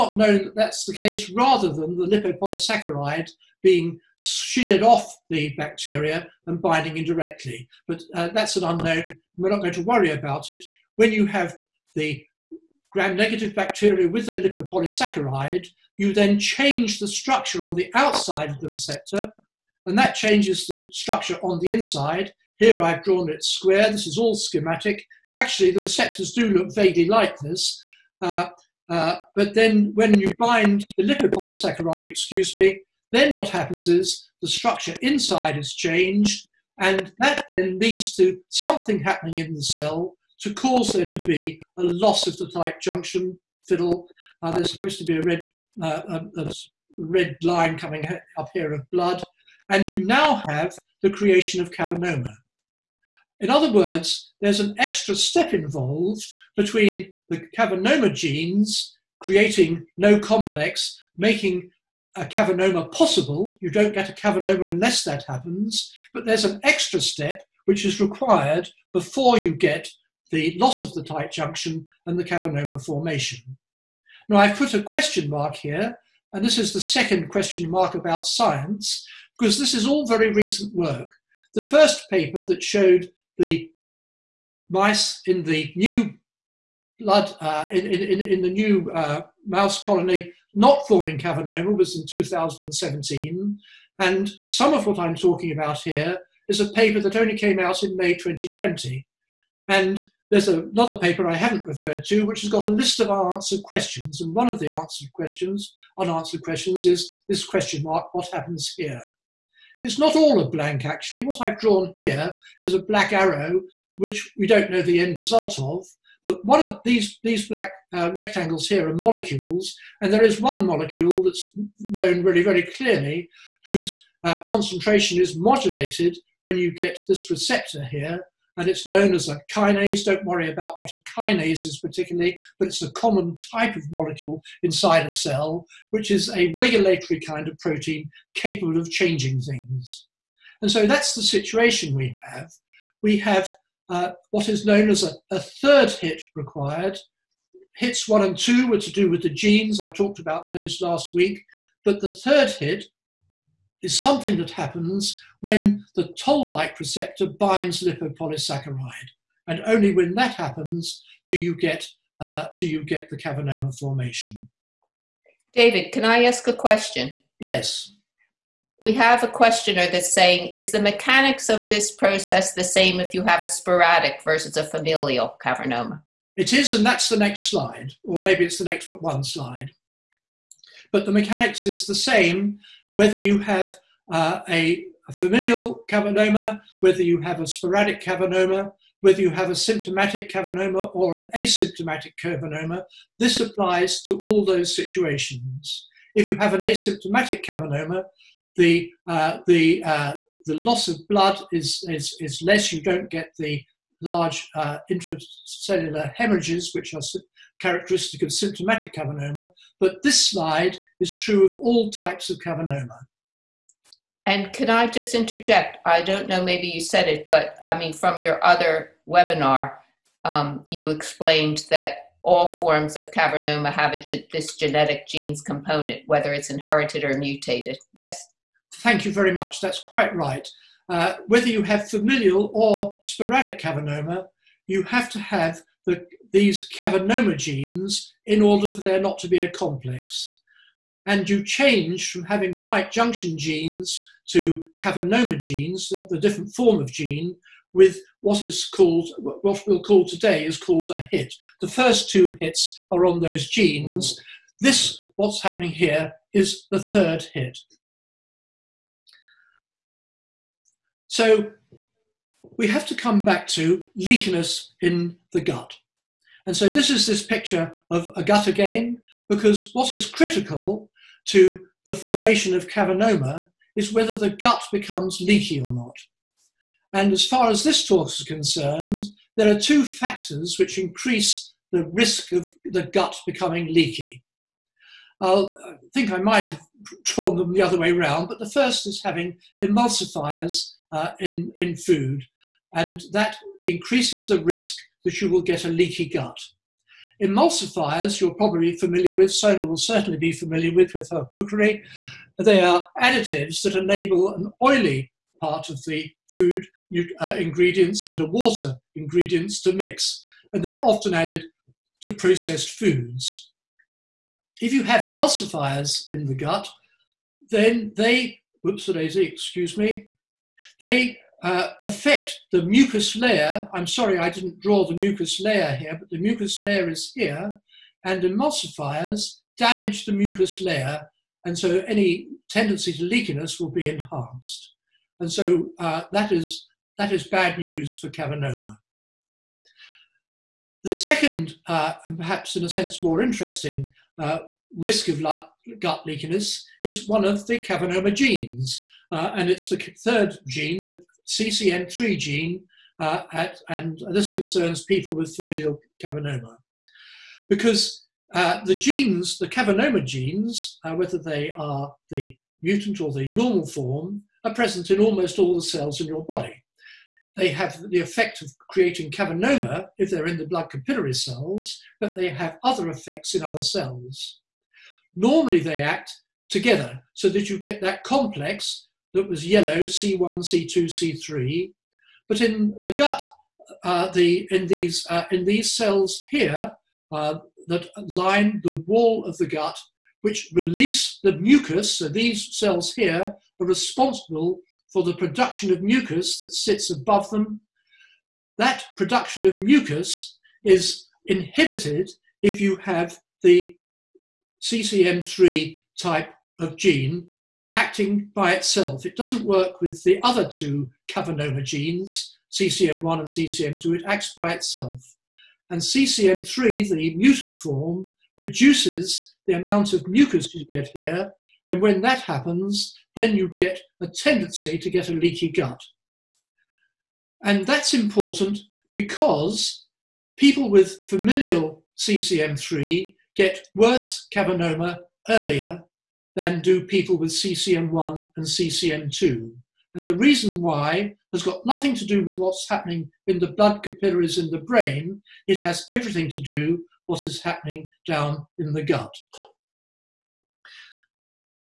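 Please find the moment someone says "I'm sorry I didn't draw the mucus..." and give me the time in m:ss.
5:23.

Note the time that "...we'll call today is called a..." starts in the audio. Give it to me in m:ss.
4:09.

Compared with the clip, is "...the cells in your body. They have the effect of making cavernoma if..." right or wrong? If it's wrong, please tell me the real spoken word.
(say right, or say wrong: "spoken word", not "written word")
wrong: "creating", not "making".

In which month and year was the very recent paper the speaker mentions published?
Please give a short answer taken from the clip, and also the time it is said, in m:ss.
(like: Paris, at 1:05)
May 2020, at 1:37.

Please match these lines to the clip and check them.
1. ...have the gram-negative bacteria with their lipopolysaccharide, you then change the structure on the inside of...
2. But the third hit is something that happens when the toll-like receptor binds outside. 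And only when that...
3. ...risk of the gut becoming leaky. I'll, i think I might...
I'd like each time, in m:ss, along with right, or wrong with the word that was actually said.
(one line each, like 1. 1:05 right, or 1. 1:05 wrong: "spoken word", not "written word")
1. 0:11 wrong: "outside", not "inside"
2. 2:31 wrong: "lipopolysaccharide", not "outside"
3. 4:41 right.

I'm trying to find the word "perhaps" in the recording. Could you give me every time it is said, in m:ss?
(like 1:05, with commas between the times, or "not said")
5:42.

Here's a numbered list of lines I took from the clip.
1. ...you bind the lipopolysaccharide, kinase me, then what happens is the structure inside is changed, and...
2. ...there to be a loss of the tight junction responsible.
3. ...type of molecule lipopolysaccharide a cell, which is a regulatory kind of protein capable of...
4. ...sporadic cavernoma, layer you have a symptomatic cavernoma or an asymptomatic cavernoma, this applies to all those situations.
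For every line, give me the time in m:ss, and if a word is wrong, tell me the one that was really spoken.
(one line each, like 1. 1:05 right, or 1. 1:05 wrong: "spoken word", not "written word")
1. 0:30 wrong: "excuse", not "kinase"
2. 0:40 wrong: "fiddle", not "responsible"
3. 2:13 wrong: "inside", not "lipopolysaccharide"
4. 3:07 wrong: "whether", not "layer".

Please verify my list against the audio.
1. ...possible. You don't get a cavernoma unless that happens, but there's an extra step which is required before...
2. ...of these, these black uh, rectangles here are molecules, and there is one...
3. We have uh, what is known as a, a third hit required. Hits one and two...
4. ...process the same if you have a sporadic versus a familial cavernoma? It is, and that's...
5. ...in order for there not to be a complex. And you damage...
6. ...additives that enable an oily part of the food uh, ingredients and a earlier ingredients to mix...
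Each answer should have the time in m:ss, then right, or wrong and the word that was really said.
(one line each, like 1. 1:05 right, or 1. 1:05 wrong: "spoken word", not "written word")
1. 1:02 right
2. 1:56 right
3. 2:23 right
4. 2:51 right
5. 3:58 wrong: "change", not "damage"
6. 5:03 wrong: "water", not "earlier".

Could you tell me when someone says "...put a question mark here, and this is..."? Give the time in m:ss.
1:14.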